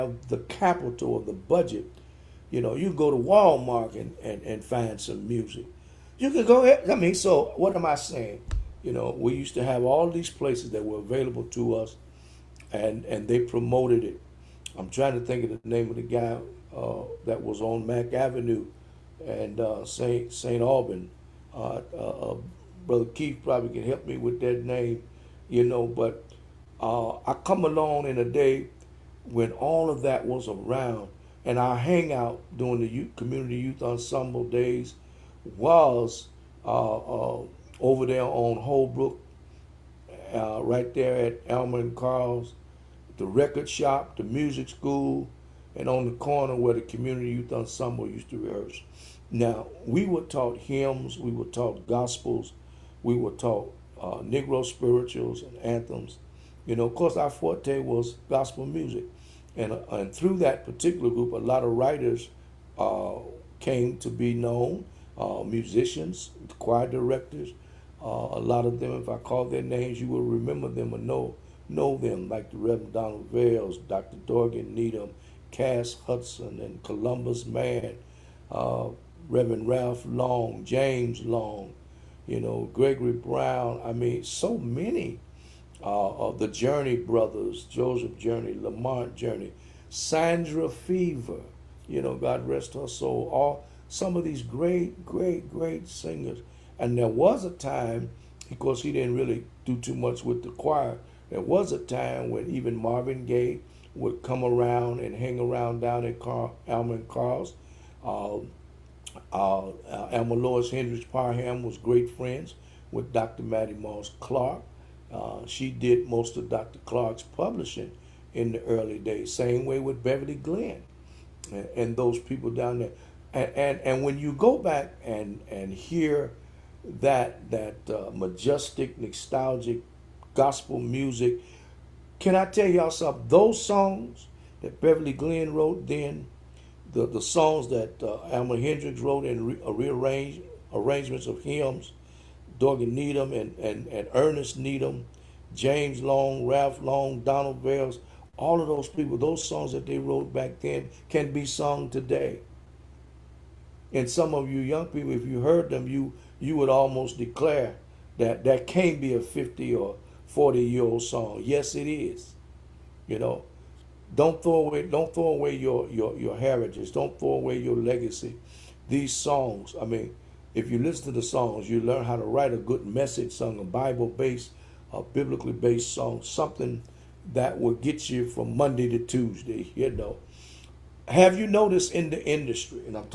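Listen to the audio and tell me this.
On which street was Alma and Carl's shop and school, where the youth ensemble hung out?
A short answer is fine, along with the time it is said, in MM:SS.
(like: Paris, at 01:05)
Holbrook, at 00:38.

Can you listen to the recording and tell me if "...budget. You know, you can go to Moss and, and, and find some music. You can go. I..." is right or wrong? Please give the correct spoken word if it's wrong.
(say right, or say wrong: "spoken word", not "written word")
wrong: "Walmart", not "Moss".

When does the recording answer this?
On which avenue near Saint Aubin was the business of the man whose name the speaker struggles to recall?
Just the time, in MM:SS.
00:17.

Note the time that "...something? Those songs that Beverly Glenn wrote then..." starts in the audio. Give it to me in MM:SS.
02:12.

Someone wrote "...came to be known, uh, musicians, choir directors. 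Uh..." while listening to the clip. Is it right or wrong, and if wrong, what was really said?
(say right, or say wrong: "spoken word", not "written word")
right.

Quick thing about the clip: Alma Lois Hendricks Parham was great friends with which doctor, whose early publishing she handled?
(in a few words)
Dr. Mattie Moss Clark.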